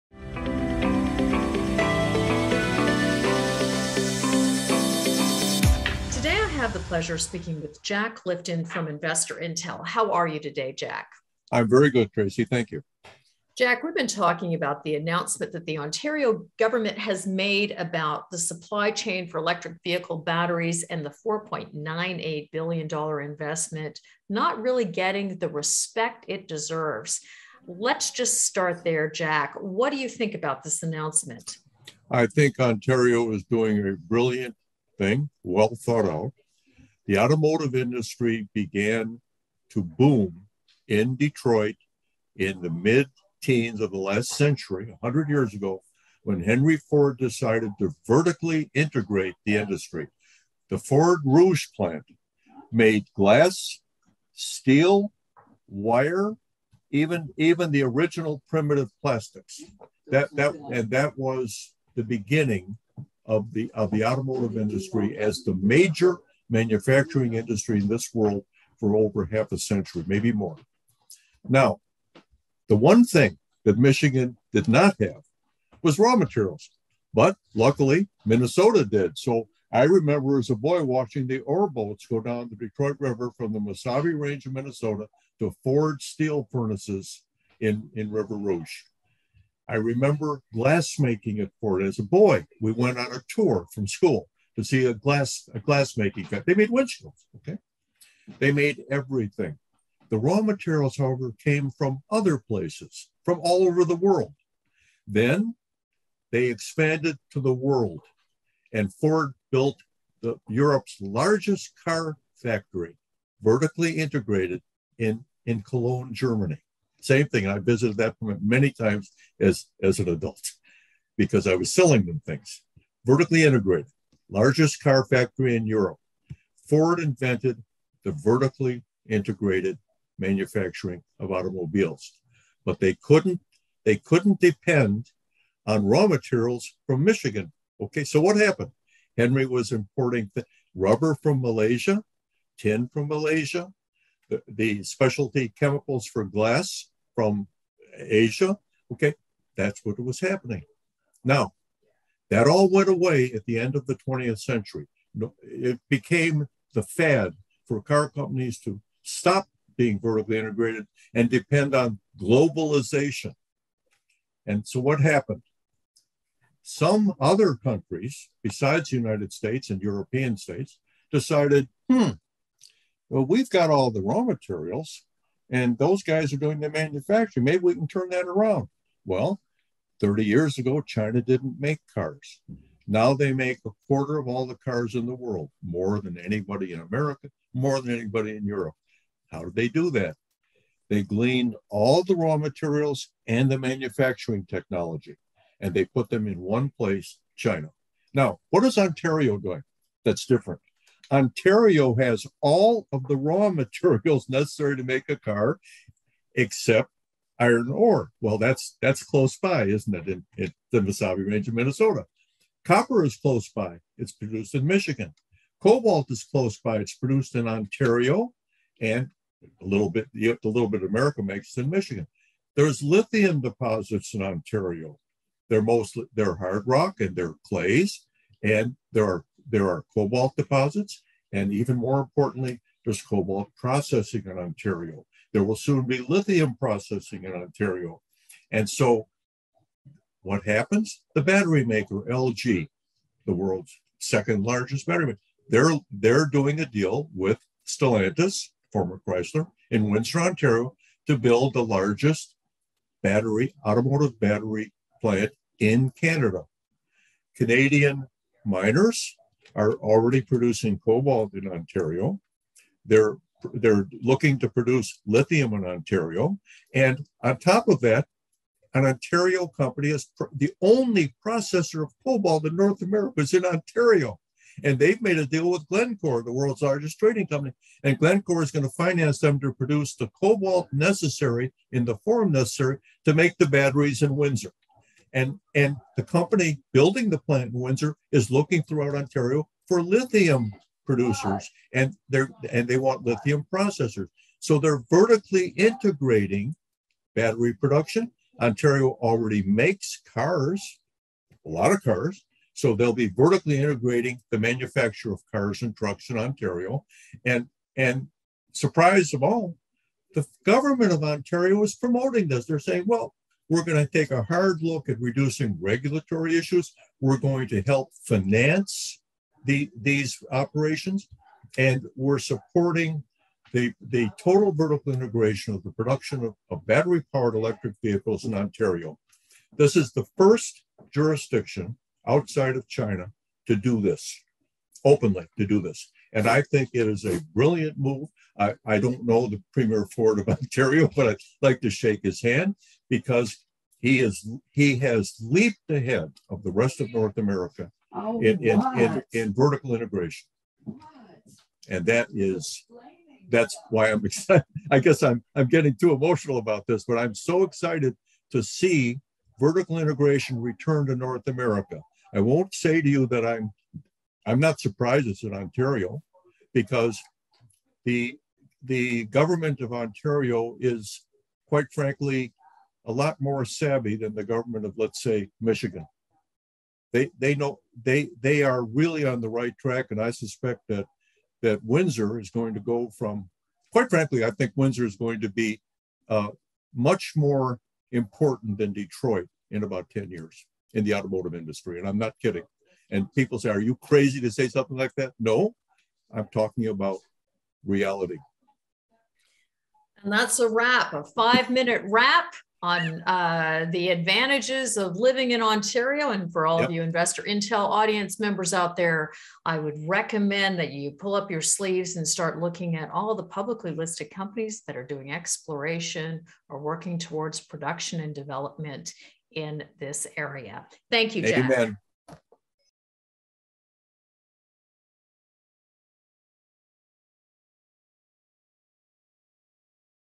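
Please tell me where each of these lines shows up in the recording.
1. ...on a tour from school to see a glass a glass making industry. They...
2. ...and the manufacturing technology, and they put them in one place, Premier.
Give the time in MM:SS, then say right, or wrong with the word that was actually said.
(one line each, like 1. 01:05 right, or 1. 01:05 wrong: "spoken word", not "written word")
1. 01:32 wrong: "factory", not "industry"
2. 03:13 wrong: "China", not "Premier".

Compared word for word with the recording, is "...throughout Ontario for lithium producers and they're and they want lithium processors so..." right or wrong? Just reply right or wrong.
right.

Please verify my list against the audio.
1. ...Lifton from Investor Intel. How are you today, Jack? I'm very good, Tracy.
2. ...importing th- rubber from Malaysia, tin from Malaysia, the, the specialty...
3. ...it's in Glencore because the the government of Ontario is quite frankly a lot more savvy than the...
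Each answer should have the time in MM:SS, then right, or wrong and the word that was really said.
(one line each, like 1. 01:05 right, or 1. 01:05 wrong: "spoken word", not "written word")
1. 00:08 right
2. 02:19 right
3. 06:05 wrong: "Ontario", not "Glencore".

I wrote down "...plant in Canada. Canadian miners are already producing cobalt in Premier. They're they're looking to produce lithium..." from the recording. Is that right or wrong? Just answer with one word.
wrong.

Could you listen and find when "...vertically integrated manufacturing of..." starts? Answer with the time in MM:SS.
02:08.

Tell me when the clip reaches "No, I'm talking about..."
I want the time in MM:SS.
06:35.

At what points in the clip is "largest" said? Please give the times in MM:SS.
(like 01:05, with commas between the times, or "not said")
01:50, 02:04, 04:04, 04:11, 04:36.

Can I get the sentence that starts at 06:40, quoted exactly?
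And that's a wrap, a five minute wrap on uh, the advantages of living in Ontario.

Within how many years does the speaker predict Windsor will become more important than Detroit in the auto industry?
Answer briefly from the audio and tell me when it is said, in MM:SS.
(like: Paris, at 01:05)
10, at 06:29.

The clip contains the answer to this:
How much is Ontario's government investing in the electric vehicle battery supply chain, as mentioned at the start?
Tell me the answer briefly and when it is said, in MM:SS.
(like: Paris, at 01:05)
$4.98 billion, at 00:21.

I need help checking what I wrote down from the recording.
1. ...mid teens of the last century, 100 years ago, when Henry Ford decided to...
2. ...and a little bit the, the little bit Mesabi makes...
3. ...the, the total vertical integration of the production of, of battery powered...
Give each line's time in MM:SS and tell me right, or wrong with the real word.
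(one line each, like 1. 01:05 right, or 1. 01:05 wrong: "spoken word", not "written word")
1. 00:42 right
2. 03:38 wrong: "America", not "Mesabi"
3. 05:23 right.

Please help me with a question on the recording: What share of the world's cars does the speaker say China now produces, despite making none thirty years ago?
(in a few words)
A quarter.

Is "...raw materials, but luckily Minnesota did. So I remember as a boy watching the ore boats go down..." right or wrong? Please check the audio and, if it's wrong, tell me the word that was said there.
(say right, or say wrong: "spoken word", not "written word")
right.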